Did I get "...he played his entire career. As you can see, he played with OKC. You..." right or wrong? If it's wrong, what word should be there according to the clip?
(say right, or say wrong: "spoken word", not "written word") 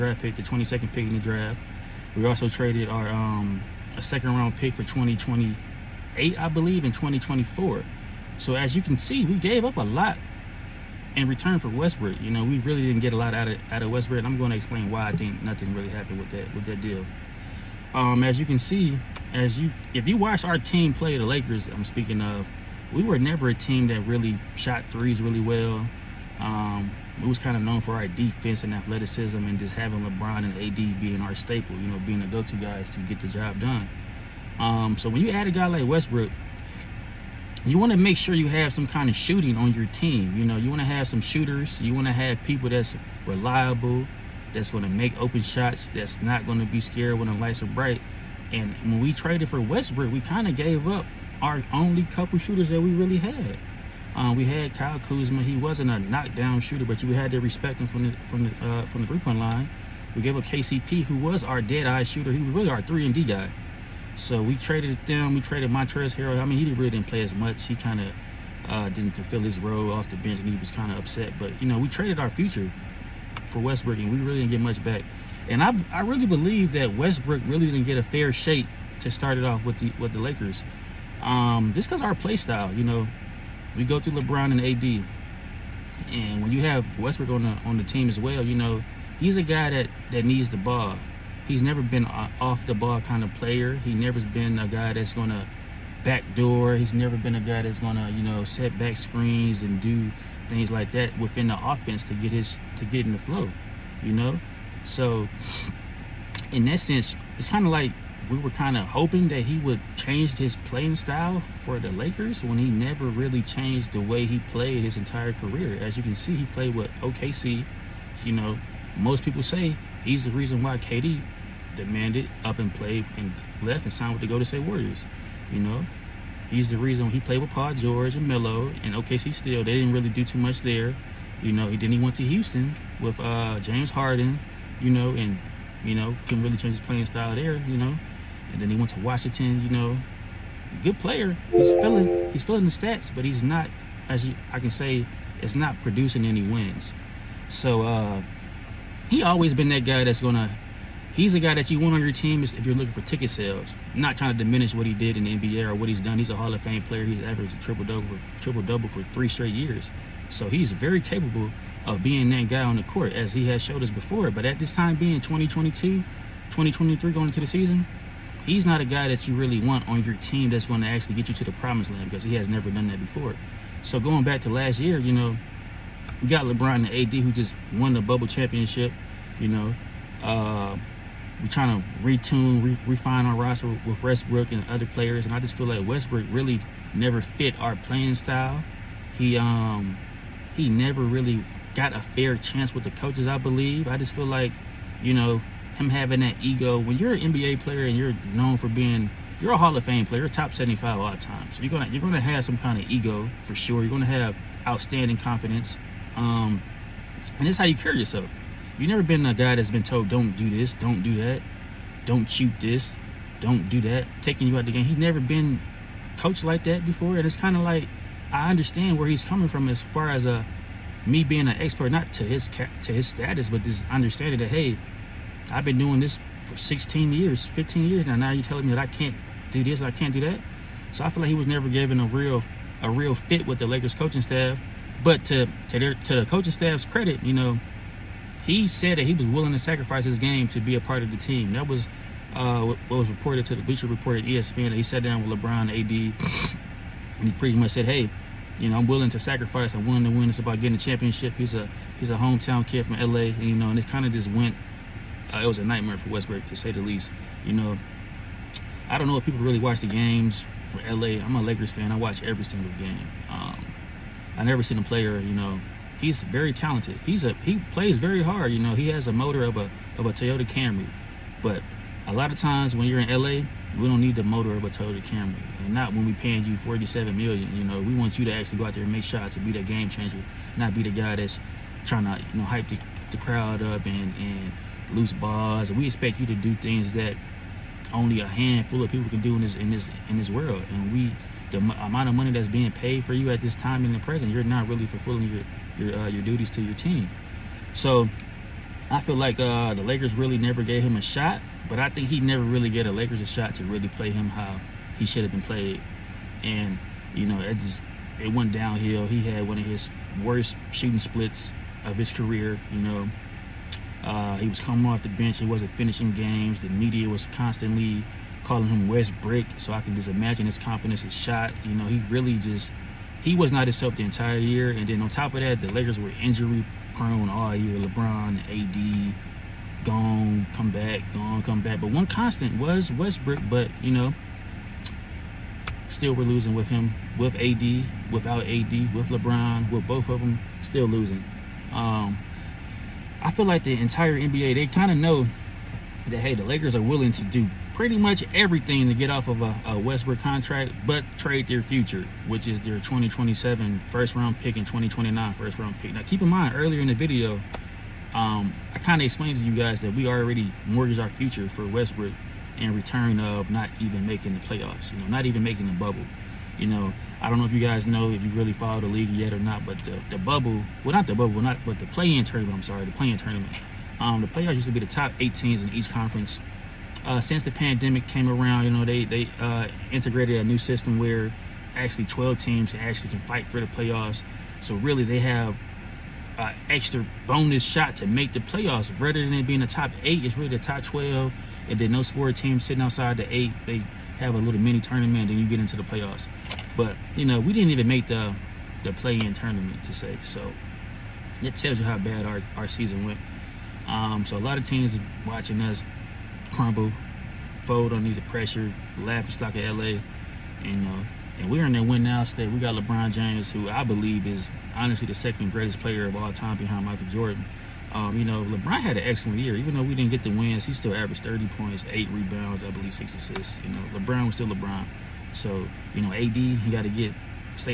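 right.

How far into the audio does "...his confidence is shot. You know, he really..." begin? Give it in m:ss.
5:20.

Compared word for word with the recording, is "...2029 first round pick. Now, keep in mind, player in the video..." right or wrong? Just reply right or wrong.
wrong.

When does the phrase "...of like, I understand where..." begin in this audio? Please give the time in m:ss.
3:37.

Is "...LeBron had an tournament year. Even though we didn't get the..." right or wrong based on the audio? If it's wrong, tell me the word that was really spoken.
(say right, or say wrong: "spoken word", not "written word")
wrong: "excellent", not "tournament".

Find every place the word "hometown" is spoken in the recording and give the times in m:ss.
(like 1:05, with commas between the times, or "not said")
4:12.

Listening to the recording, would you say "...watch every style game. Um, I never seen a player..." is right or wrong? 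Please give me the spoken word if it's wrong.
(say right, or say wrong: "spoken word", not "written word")
wrong: "single", not "style".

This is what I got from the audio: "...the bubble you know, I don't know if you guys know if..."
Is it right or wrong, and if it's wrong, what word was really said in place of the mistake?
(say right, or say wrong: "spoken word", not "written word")
right.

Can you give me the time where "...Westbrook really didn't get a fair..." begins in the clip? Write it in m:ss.
1:16.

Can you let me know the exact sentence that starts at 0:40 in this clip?
You know, you want to have some shooters.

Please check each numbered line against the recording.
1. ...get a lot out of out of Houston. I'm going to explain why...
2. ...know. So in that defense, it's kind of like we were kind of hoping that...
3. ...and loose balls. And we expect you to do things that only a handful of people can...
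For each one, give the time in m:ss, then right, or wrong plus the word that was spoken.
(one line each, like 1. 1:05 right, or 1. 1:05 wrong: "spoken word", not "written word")
1. 0:13 wrong: "Westbrook", not "Houston"
2. 1:44 wrong: "sense", not "defense"
3. 4:44 right.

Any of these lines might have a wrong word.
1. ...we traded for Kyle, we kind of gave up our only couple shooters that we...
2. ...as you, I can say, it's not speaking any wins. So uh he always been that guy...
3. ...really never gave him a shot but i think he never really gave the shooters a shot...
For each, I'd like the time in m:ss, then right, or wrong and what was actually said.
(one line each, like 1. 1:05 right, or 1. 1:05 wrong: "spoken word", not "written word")
1. 0:49 wrong: "Westbrook", not "Kyle"
2. 2:24 wrong: "producing", not "speaking"
3. 5:00 wrong: "lakers", not "shooters".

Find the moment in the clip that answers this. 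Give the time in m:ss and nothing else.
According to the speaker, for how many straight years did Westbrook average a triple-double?
2:39.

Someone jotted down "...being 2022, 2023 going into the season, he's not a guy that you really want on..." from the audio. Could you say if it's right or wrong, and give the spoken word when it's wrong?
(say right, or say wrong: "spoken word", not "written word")
right.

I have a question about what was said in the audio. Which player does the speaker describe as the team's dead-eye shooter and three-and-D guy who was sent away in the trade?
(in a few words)
KCP.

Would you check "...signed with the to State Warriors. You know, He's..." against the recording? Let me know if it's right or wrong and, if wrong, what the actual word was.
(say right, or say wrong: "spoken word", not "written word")
right.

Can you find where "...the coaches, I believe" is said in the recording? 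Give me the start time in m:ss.
3:12.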